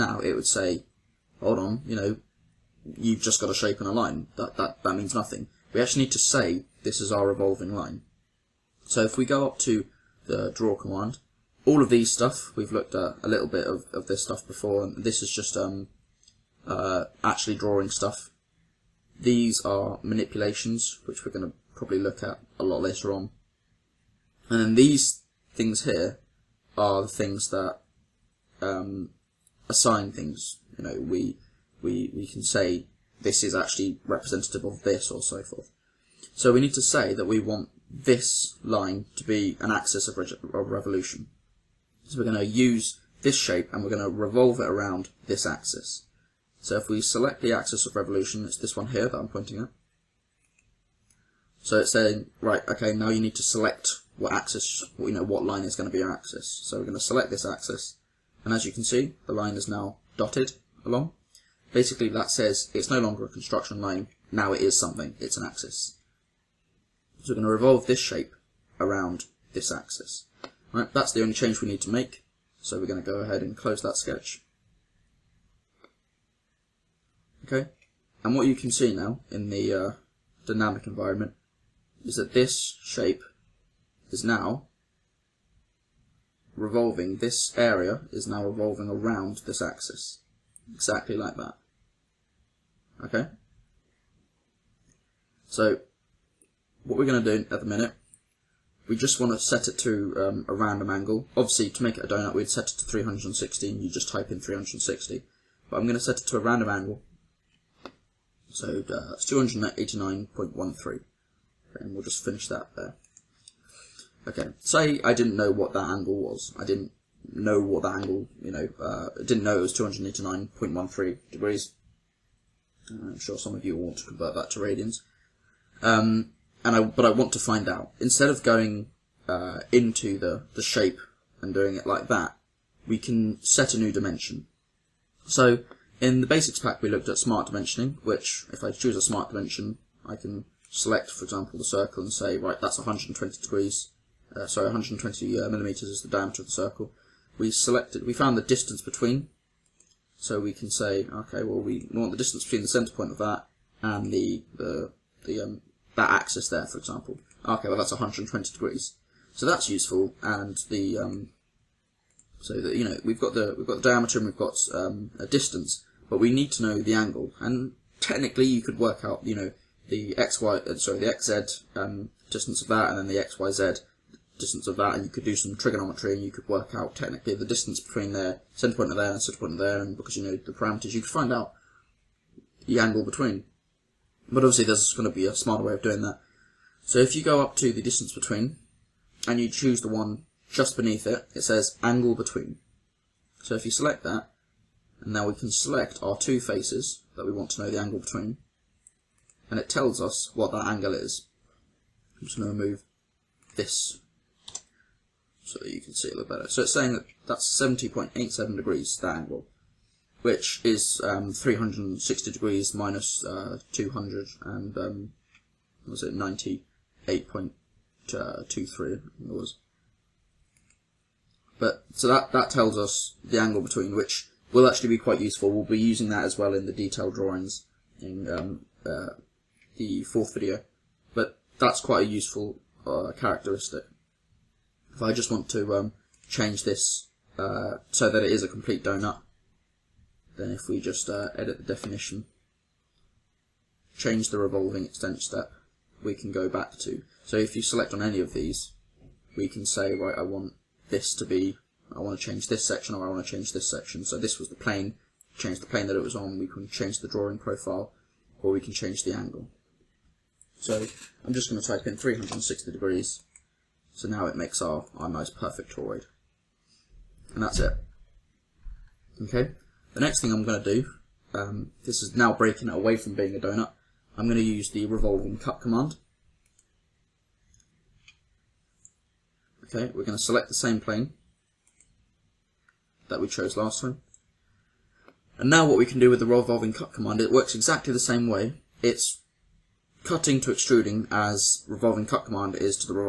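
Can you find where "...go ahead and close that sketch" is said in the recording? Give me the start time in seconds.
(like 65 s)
73 s.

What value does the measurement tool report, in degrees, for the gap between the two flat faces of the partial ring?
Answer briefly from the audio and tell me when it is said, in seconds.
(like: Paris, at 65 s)
70.87 degrees, at 207 s.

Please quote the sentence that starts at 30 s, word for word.
You know, we, we, we can say this is actually representative of this or so forth.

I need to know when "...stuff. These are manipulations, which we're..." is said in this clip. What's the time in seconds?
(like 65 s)
17 s.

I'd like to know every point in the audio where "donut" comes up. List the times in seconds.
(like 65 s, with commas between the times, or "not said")
102 s, 238 s, 273 s.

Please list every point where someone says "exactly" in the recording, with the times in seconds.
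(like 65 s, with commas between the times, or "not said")
90 s, 287 s.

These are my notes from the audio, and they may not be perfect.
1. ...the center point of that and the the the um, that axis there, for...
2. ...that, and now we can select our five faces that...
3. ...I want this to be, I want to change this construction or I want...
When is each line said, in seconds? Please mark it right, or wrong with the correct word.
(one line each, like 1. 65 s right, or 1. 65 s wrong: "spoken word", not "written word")
1. 152 s right
2. 194 s wrong: "two", not "five"
3. 250 s wrong: "section", not "construction".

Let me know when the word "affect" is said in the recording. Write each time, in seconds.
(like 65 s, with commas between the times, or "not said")
not said.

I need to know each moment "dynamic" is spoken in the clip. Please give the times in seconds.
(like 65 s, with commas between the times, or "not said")
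80 s.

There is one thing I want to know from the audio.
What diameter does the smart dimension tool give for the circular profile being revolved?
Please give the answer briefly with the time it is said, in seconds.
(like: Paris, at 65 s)
120 millimeters, at 144 s.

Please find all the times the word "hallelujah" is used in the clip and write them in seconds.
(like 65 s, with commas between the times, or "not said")
not said.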